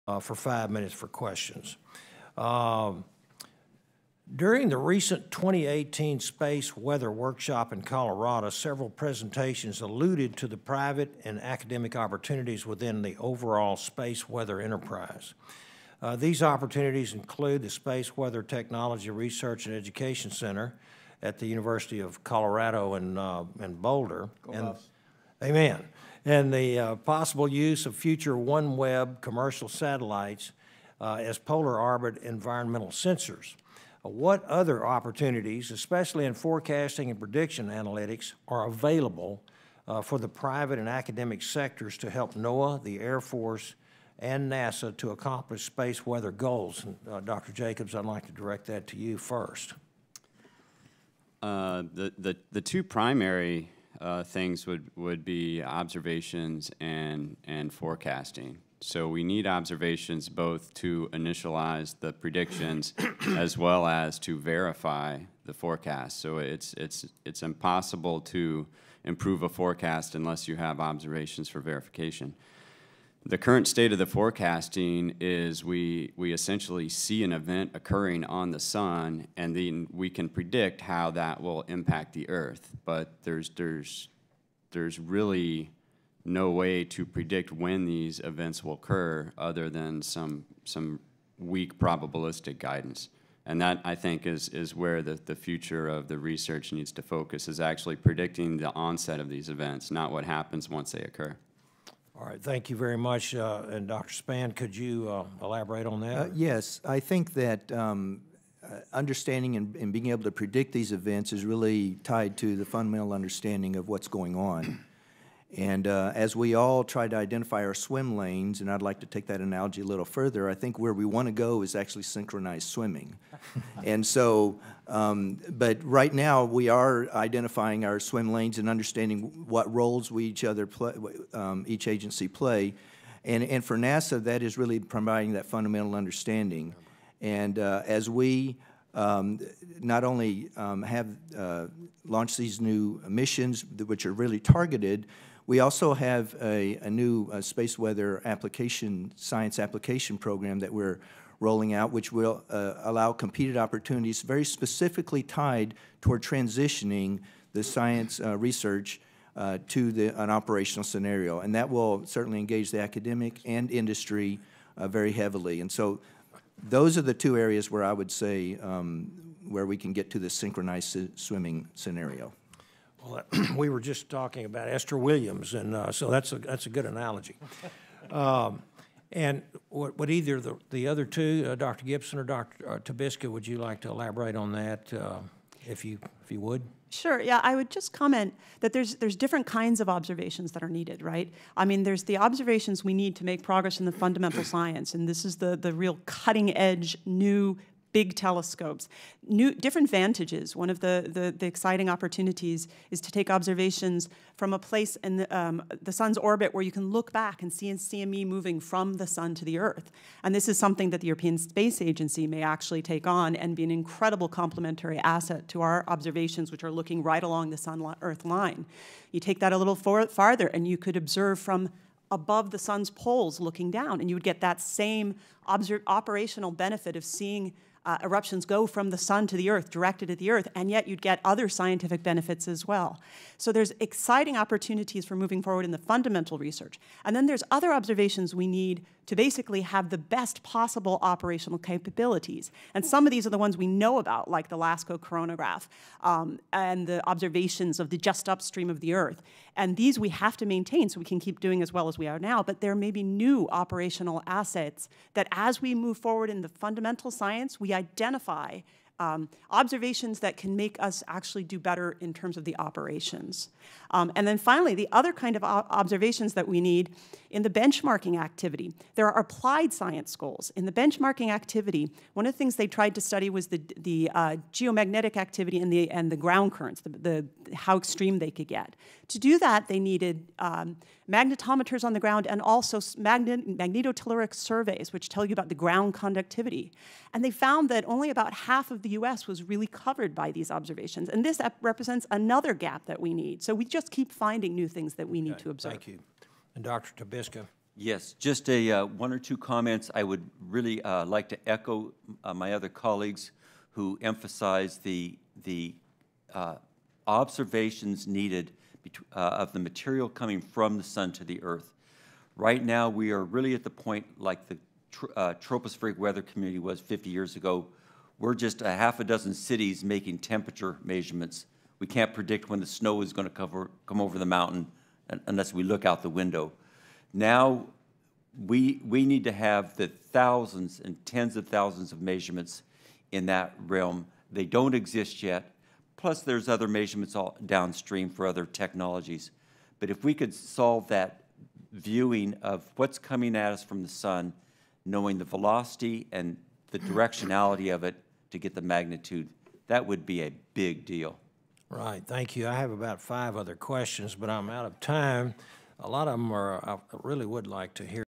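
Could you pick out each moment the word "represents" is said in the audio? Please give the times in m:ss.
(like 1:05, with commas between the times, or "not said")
4:51.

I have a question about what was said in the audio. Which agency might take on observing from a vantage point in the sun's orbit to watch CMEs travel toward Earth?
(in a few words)
European Space Agency.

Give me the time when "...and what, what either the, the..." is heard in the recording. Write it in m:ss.
2:59.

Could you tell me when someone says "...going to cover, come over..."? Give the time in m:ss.
5:23.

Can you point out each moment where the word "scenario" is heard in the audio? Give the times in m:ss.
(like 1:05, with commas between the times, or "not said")
2:40, 2:51.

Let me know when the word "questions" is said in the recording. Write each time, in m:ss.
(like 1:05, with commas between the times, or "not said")
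0:01, 5:53.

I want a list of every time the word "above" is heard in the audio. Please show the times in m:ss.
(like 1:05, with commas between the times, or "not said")
3:42.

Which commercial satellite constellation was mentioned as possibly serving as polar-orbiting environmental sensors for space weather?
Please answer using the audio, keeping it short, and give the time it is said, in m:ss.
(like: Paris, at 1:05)
OneWeb, at 0:28.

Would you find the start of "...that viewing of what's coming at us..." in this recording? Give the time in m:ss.
5:40.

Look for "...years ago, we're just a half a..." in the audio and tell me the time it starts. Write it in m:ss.
5:17.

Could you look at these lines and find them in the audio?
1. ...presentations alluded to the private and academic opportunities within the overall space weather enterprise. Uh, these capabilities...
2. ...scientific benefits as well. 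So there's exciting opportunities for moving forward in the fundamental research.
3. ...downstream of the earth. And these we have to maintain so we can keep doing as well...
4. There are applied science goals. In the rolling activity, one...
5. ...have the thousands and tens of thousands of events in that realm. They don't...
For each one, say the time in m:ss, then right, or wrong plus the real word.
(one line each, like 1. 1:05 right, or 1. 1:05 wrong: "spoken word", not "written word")
1. 0:08 wrong: "opportunities", not "capabilities"
2. 3:51 right
3. 4:08 wrong: "upstream", not "downstream"
4. 4:28 wrong: "benchmarking", not "rolling"
5. 5:29 wrong: "measurements", not "events".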